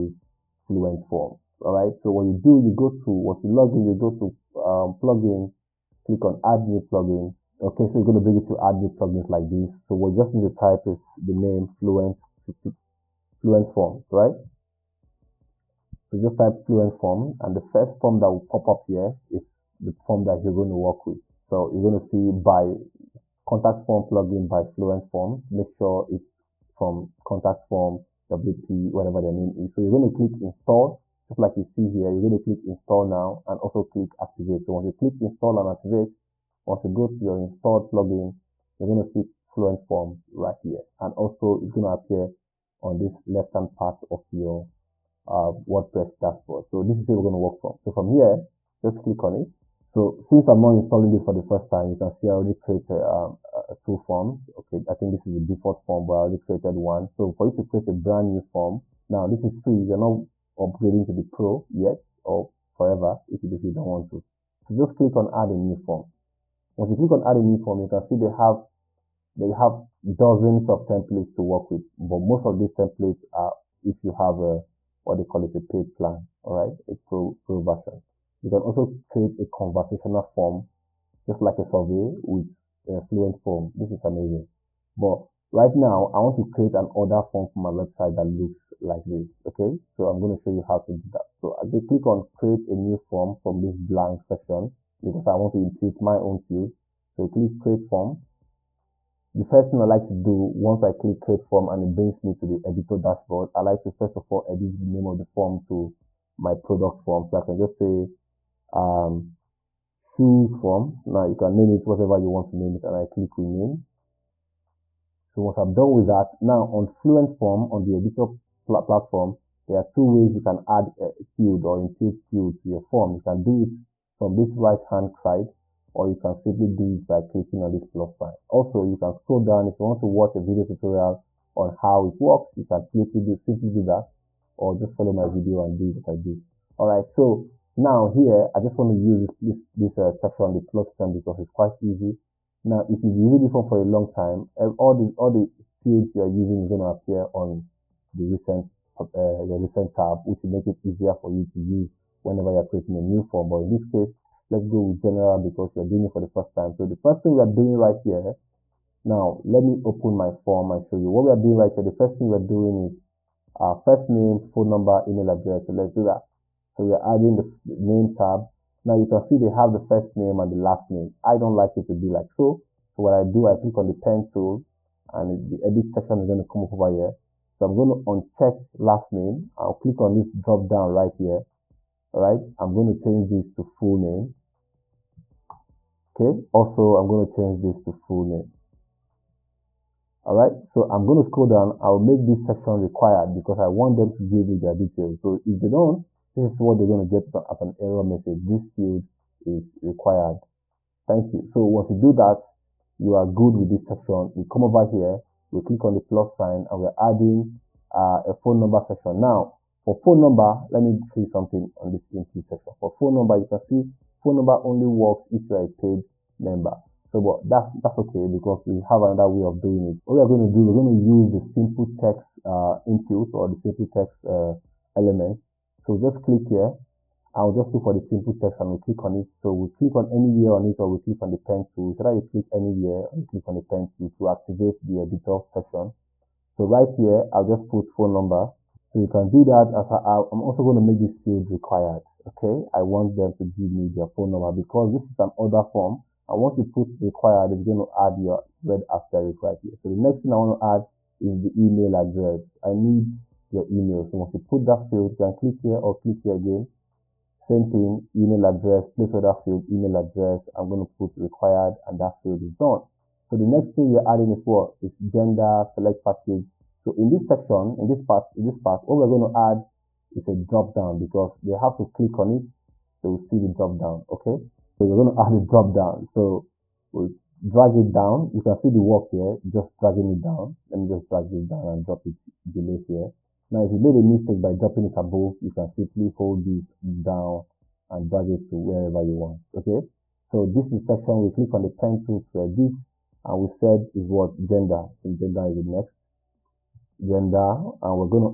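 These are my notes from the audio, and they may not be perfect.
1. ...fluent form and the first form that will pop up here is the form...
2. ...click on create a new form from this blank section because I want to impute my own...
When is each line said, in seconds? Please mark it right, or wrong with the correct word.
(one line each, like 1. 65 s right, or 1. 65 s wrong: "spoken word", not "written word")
1. 16 s right
2. 91 s right.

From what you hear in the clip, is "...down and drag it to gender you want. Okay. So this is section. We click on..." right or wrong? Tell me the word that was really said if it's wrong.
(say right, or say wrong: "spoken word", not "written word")
wrong: "wherever", not "gender".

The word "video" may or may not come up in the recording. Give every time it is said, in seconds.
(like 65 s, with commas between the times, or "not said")
130 s, 135 s.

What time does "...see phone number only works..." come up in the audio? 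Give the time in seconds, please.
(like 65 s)
213 s.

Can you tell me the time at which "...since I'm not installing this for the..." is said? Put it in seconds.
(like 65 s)
50 s.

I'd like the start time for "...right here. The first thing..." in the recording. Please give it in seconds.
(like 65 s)
161 s.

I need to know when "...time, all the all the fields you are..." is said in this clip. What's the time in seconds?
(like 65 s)
144 s.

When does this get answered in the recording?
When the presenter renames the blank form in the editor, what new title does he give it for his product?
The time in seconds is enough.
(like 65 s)
109 s.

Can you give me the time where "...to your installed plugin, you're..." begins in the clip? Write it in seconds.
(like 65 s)
37 s.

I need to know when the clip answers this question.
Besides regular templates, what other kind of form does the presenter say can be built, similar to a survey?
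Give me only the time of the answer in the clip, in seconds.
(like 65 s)
79 s.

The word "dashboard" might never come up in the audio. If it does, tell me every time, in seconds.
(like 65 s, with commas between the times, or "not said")
46 s, 102 s.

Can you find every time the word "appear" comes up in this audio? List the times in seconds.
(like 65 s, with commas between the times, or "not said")
41 s, 146 s.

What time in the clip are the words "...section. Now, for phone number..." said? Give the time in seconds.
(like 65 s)
208 s.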